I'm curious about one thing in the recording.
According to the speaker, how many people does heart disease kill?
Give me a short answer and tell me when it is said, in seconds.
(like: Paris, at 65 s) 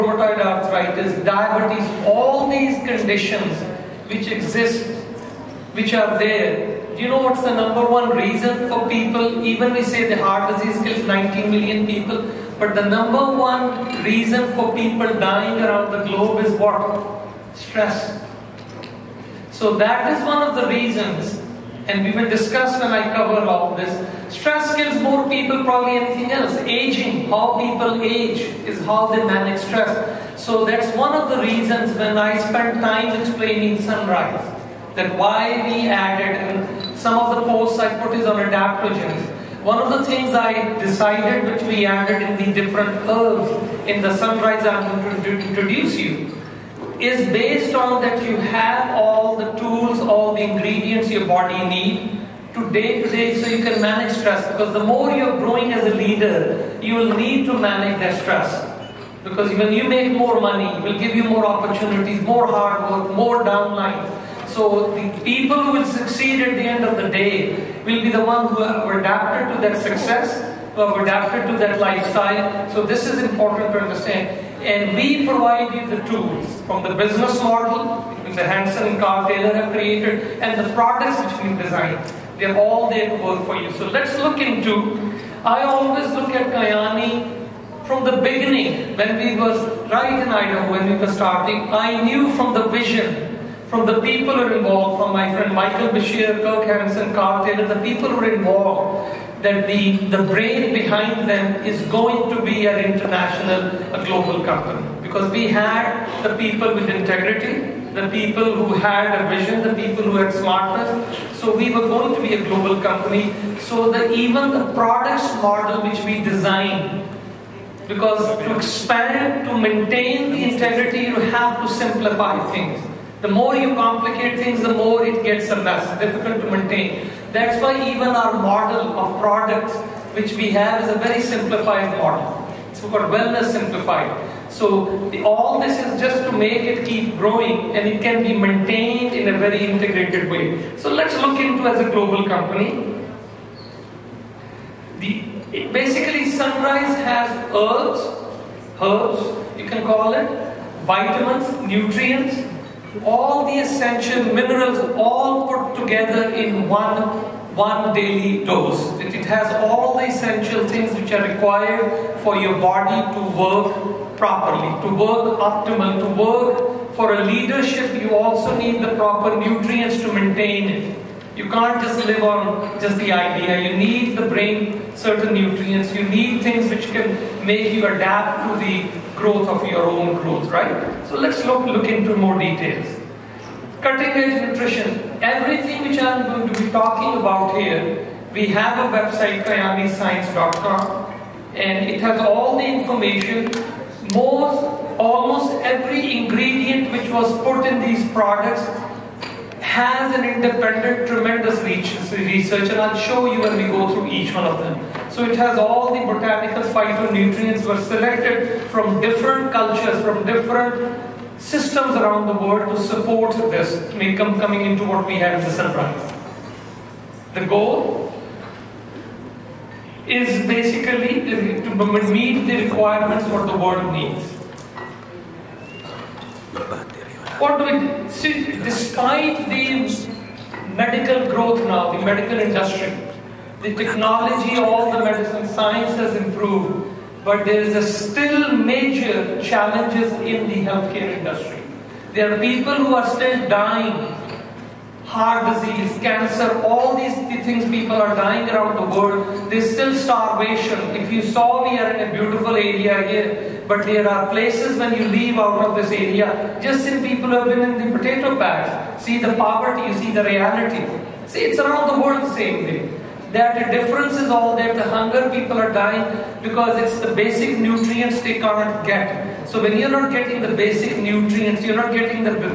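19 million, at 11 s.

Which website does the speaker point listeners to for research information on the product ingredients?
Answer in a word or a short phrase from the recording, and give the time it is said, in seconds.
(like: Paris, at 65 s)
kyaniscience.com, at 189 s.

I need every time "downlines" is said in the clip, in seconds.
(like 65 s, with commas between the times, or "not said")
63 s.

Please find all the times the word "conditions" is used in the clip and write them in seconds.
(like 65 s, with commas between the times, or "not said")
2 s.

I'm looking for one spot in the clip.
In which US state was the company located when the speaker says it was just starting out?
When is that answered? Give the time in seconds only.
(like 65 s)
90 s.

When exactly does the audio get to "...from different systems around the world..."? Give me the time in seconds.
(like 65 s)
210 s.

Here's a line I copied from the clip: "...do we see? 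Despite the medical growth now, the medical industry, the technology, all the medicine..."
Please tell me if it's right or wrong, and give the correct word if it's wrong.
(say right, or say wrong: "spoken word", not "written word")
right.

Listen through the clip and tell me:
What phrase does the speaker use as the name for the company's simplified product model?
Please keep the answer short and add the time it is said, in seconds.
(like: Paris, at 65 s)
wellness simplified, at 133 s.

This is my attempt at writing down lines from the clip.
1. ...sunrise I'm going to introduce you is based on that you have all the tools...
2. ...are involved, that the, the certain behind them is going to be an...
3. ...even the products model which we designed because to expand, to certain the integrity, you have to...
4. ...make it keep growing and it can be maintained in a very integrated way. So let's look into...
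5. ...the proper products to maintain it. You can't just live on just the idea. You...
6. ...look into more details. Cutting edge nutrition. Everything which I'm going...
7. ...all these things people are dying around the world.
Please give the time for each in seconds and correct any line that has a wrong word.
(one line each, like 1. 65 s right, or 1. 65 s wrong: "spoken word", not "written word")
1. 44 s right
2. 98 s wrong: "brain", not "certain"
3. 114 s wrong: "maintain", not "certain"
4. 136 s right
5. 168 s wrong: "nutrients", not "products"
6. 181 s right
7. 246 s right.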